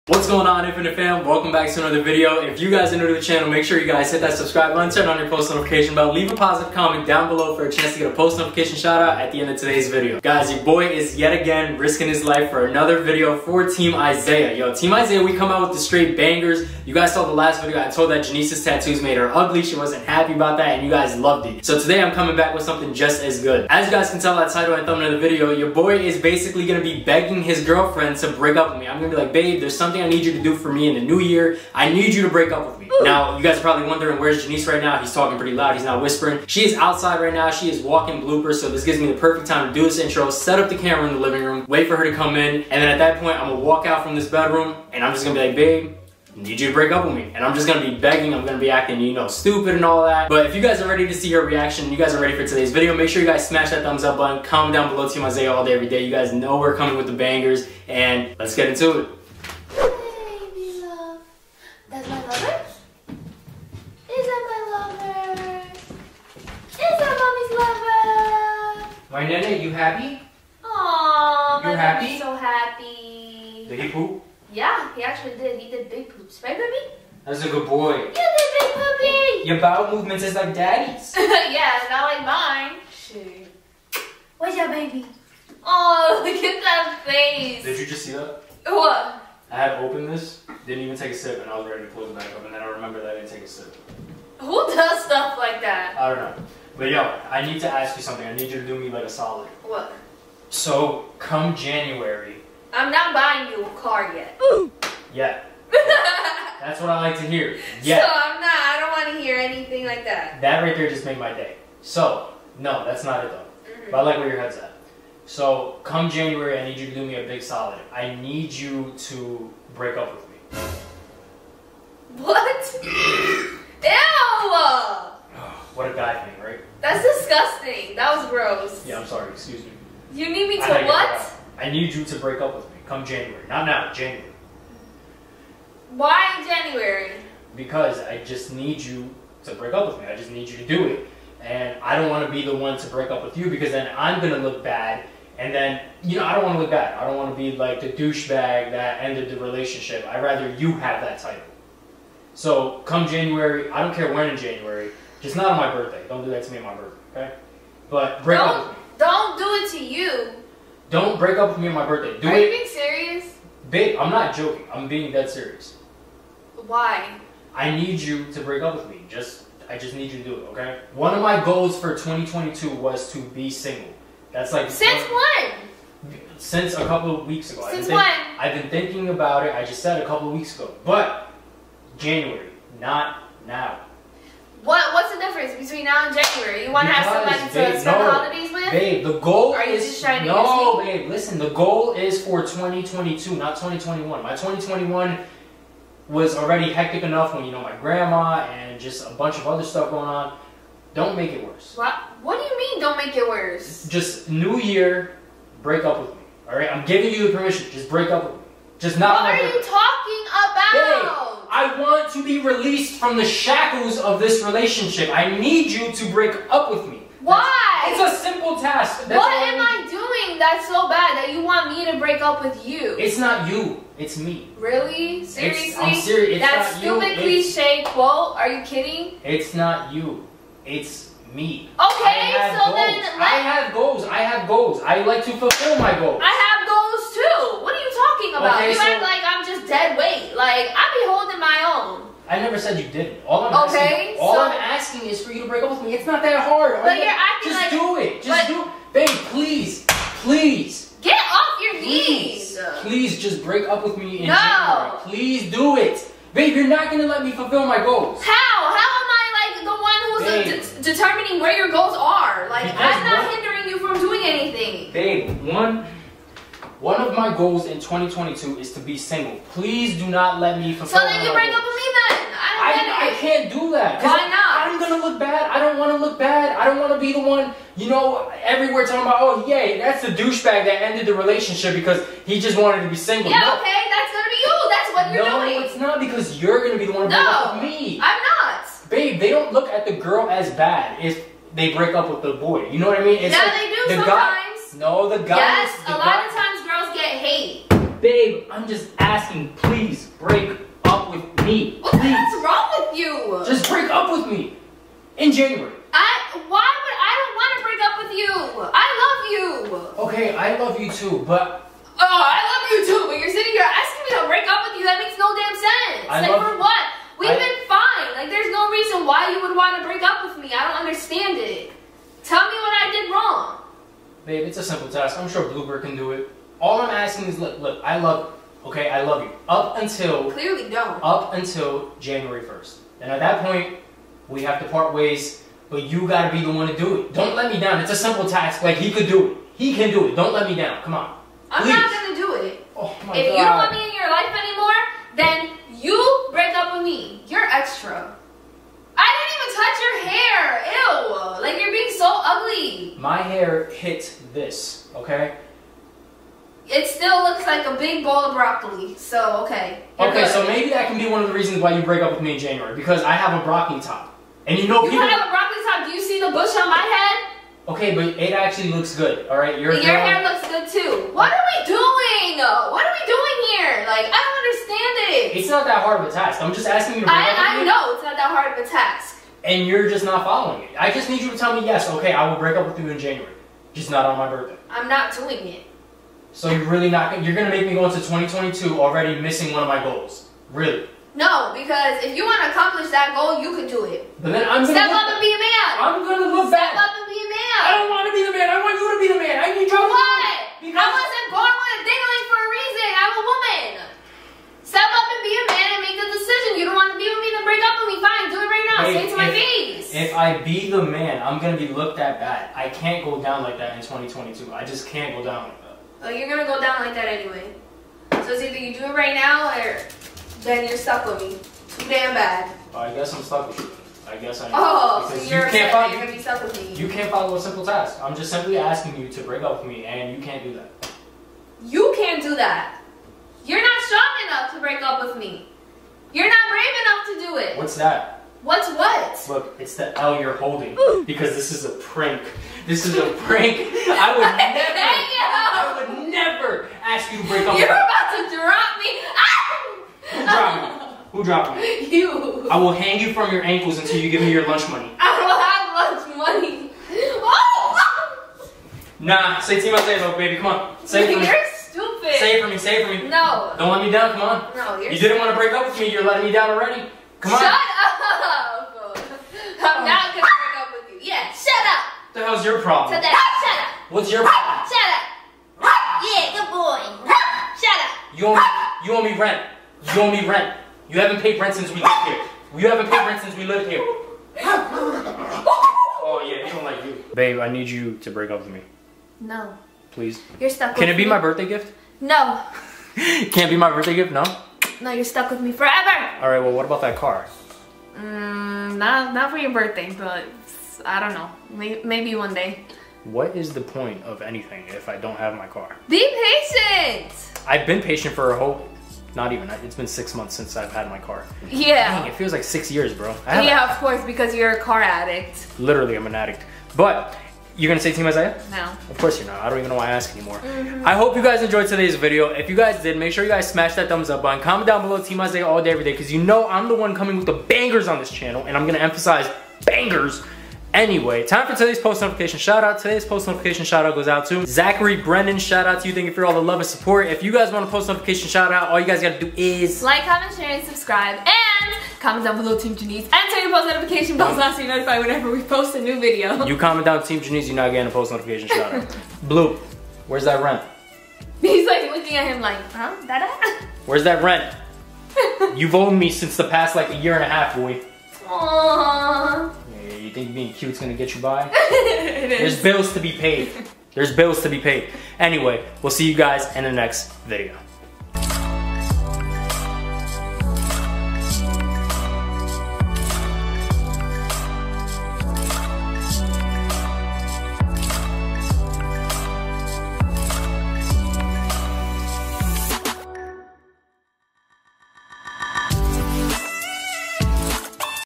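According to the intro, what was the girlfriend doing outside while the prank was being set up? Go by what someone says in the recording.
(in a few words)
walking Bloopers.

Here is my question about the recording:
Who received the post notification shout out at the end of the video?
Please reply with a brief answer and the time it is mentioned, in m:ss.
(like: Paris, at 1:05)
Zachary Brennan, at 8:54.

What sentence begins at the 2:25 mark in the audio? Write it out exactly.
And then, you know, I don't want to look bad.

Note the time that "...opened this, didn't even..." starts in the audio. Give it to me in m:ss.
1:29.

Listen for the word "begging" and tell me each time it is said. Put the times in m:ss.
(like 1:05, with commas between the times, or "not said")
0:27, 0:47.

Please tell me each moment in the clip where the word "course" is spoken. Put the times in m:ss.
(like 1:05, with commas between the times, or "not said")
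8:33, 8:38.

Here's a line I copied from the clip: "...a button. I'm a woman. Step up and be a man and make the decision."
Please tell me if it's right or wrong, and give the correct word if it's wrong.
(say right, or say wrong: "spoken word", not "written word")
wrong: "reason", not "button".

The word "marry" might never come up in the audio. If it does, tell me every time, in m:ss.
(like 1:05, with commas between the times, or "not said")
not said.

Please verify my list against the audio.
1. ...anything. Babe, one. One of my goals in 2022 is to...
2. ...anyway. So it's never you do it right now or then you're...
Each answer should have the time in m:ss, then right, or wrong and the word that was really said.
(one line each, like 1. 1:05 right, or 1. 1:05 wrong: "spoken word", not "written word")
1. 4:24 right
2. 6:57 wrong: "either", not "never".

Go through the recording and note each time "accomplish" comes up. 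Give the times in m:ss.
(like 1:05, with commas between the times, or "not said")
6:32.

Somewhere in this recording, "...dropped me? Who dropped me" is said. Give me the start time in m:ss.
7:30.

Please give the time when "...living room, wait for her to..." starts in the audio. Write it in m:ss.
0:41.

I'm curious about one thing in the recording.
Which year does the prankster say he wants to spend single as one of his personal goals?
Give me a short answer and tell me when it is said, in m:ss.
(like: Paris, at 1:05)
2022, at 2:50.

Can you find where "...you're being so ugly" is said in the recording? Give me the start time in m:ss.
5:51.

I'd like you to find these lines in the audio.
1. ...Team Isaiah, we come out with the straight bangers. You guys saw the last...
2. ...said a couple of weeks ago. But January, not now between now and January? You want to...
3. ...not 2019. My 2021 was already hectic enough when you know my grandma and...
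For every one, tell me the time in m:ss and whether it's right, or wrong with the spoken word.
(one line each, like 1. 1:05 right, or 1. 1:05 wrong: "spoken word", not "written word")
1. 0:14 right
2. 2:59 right
3. 3:13 wrong: "2021", not "2019".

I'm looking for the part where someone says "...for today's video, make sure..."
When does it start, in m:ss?
0:52.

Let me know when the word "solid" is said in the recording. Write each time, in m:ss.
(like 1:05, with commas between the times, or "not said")
1:39, 1:57.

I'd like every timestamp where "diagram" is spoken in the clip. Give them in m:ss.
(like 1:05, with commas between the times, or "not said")
not said.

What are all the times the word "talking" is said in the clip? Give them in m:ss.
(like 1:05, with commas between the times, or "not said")
0:35, 3:29, 3:57, 4:38.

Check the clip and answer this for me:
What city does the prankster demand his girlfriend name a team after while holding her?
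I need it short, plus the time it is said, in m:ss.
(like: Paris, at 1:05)
Atlanta, at 7:39.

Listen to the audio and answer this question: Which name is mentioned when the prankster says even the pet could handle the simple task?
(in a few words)
Bluebird.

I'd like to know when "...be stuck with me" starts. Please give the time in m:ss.
7:06.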